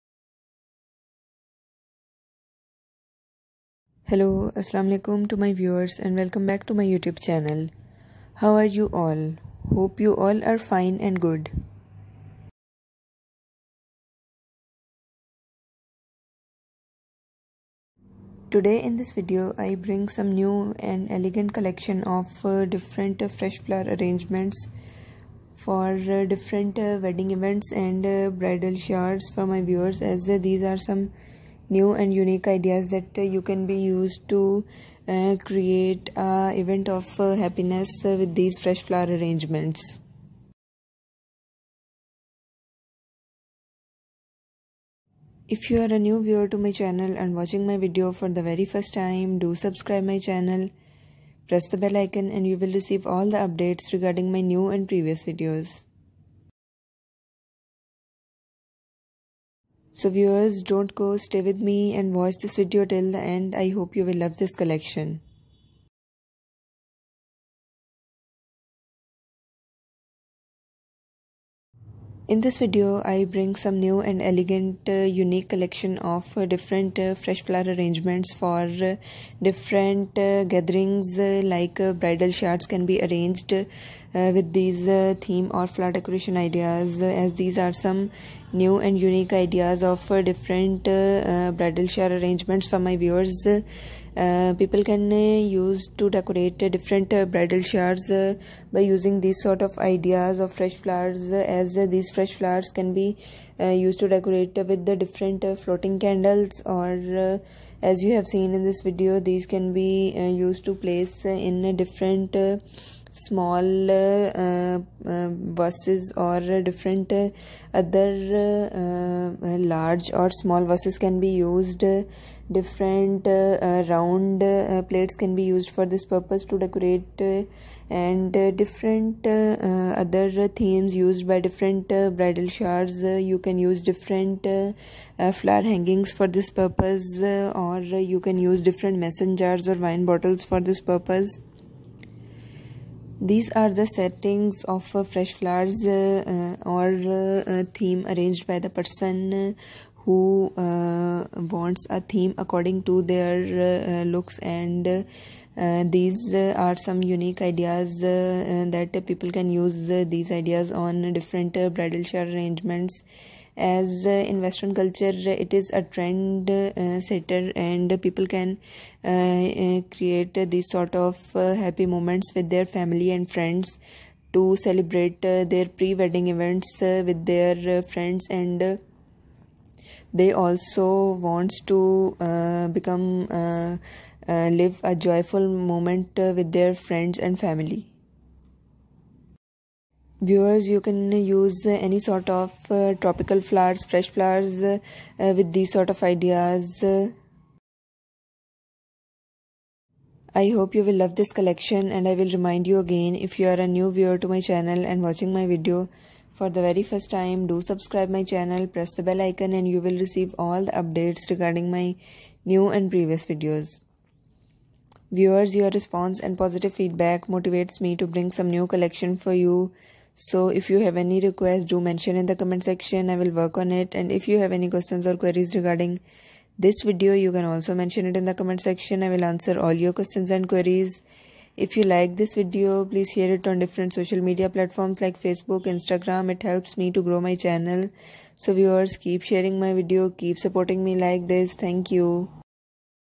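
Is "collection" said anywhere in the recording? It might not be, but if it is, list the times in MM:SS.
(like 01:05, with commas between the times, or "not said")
00:21, 01:04, 01:15, 03:21, 03:38.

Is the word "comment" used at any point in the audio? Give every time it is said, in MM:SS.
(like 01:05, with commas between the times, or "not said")
03:42, 03:48.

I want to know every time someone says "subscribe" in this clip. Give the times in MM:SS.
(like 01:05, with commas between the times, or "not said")
00:49, 03:27.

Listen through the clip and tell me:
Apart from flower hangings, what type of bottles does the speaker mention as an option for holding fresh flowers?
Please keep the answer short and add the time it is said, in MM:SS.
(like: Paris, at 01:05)
Wine bottles, at 02:19.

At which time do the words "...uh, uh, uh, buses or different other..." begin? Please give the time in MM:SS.
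01:53.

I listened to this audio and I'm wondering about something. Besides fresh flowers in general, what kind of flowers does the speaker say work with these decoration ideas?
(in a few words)
Tropical flowers.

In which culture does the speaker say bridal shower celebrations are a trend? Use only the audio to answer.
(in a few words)
Western culture.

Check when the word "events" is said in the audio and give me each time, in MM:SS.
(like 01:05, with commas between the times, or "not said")
00:27, 00:36, 02:56.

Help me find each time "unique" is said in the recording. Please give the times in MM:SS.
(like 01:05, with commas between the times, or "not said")
00:32, 01:15, 01:28, 02:37.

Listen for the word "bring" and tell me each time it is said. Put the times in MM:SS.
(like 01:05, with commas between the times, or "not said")
00:19, 01:13, 03:38.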